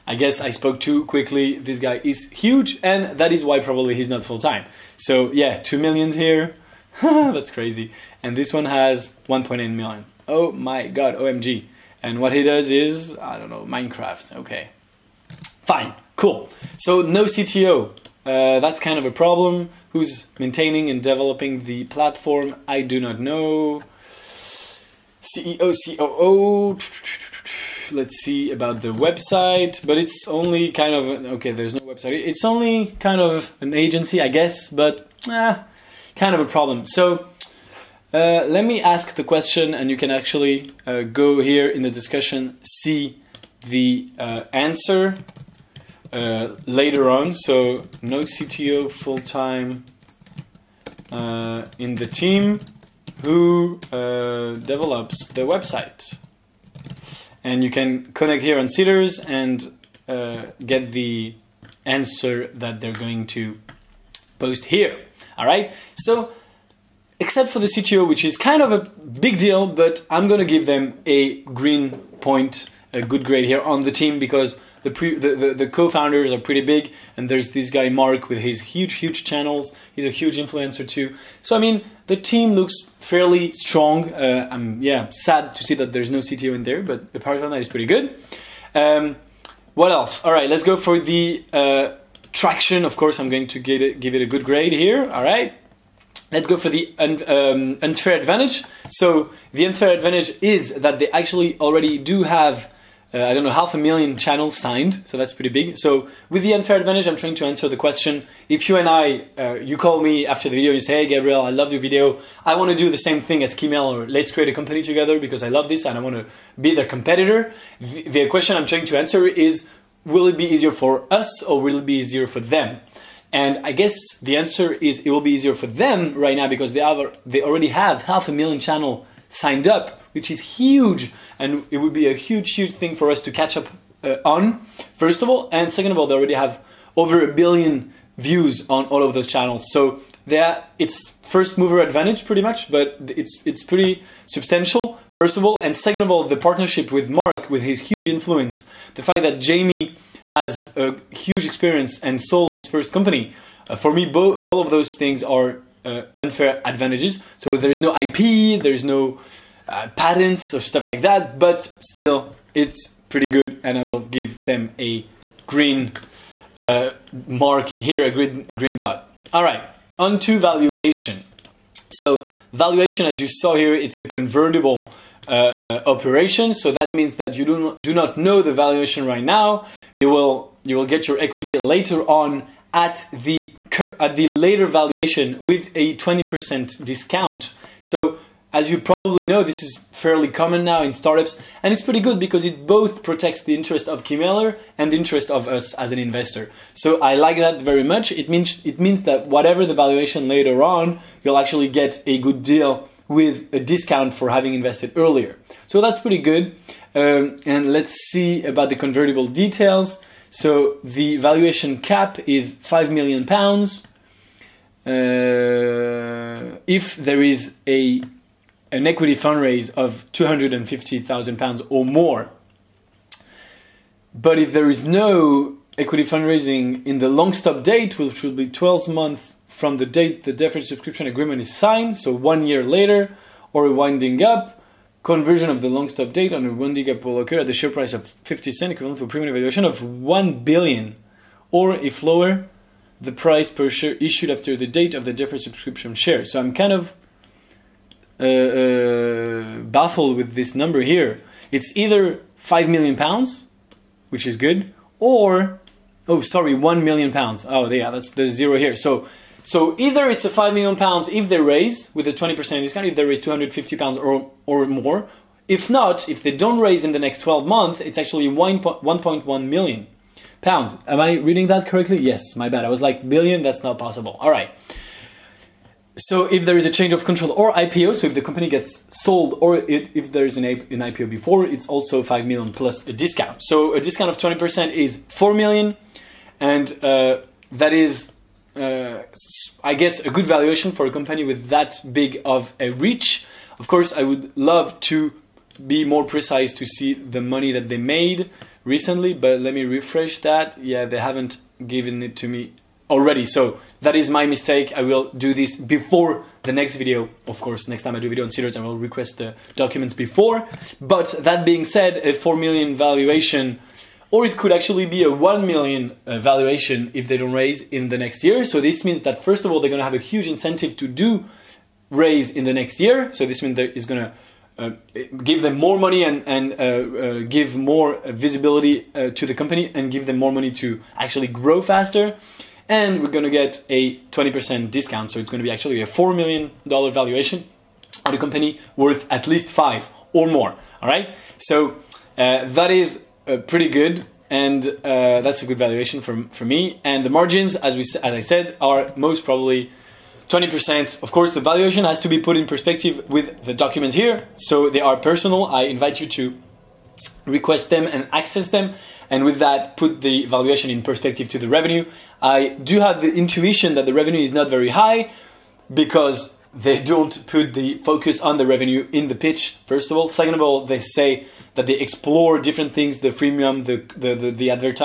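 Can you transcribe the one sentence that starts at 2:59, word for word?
You will you will get your equity later on at the at the later valuation with a 20% discount.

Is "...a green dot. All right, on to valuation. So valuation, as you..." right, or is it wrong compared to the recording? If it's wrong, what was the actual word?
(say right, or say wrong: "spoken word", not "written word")
right.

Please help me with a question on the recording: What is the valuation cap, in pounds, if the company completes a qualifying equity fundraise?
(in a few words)
5 million pounds.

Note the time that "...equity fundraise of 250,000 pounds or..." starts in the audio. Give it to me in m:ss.
3:38.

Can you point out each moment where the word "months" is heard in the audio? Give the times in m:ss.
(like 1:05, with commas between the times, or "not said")
3:48, 4:27.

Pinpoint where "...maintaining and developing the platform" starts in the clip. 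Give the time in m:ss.
0:20.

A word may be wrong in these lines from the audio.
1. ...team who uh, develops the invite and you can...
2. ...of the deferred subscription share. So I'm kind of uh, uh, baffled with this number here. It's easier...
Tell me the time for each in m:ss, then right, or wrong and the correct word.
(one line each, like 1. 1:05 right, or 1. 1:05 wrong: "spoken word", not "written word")
1. 0:52 wrong: "website", not "invite"
2. 4:04 wrong: "either", not "easier".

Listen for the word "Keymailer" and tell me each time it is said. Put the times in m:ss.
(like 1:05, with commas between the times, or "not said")
1:53, 3:14.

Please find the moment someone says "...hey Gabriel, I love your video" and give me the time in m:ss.
1:51.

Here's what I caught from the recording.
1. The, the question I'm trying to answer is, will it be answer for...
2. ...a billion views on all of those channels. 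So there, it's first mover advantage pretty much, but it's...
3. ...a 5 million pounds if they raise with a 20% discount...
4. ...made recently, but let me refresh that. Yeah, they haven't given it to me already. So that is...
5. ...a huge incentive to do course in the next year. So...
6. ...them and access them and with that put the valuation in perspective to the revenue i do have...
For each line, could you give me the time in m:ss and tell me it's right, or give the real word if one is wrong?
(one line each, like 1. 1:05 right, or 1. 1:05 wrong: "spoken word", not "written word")
1. 1:57 wrong: "easier", not "answer"
2. 2:17 right
3. 4:20 right
4. 4:57 right
5. 5:19 wrong: "raise", not "course"
6. 5:57 right.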